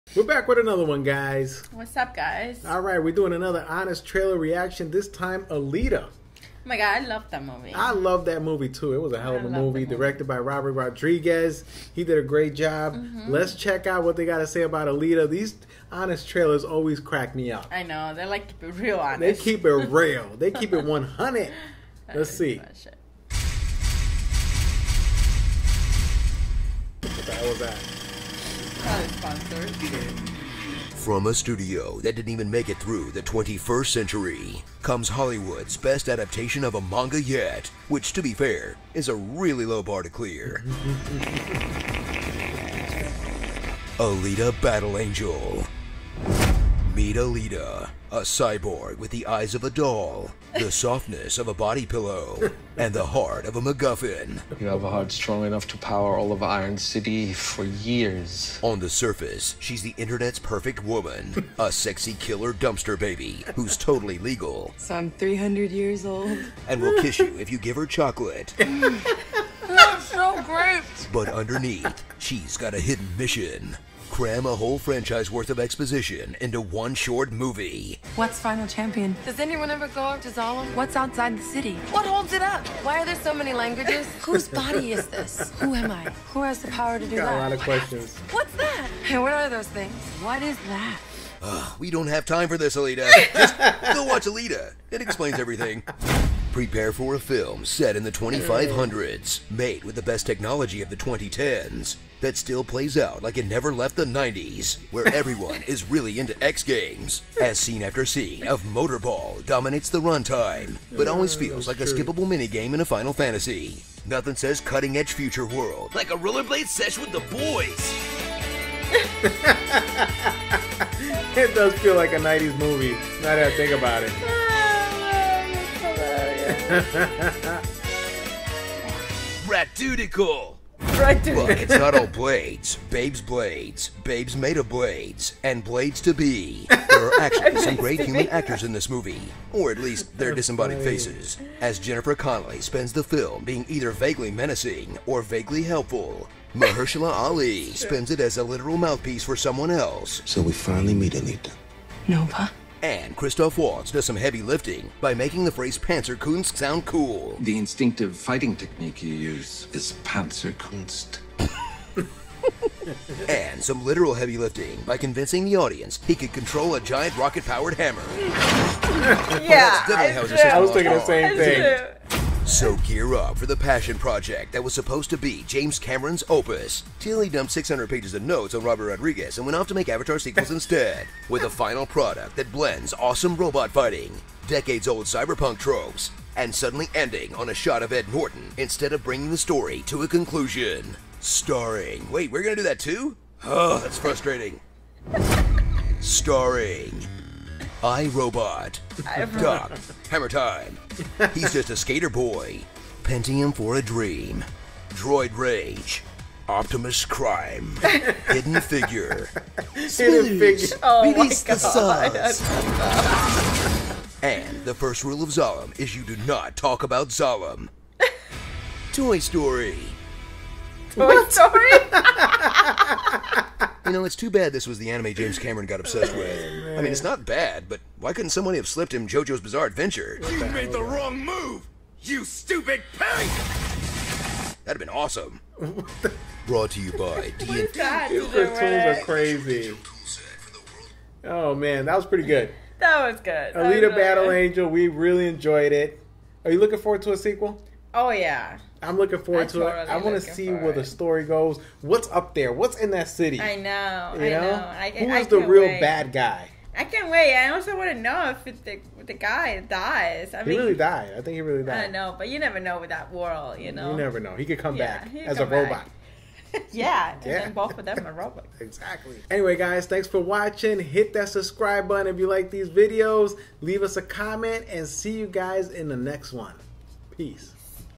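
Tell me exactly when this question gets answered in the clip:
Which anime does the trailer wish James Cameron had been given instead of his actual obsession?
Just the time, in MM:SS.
03:49.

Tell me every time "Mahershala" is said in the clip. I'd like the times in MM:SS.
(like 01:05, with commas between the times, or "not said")
02:26.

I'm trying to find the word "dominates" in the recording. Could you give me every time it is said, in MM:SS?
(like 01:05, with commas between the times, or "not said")
01:49.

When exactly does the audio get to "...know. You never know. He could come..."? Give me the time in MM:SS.
04:23.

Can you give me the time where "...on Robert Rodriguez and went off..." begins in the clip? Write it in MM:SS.
02:58.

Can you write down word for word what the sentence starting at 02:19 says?
Or at least their disembodied faces.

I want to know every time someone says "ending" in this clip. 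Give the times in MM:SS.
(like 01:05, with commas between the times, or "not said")
03:06.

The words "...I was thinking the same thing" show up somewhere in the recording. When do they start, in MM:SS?
02:50.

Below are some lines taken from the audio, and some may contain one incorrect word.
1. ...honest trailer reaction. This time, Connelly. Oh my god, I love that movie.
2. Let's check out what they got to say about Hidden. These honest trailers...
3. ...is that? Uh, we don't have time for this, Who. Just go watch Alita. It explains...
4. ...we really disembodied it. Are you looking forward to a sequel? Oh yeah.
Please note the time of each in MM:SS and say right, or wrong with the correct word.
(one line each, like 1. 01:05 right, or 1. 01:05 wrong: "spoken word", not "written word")
1. 00:03 wrong: "Alita", not "Connelly"
2. 00:13 wrong: "Alita", not "Hidden"
3. 01:30 wrong: "Alita", not "Who"
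4. 04:04 wrong: "enjoyed", not "disembodied".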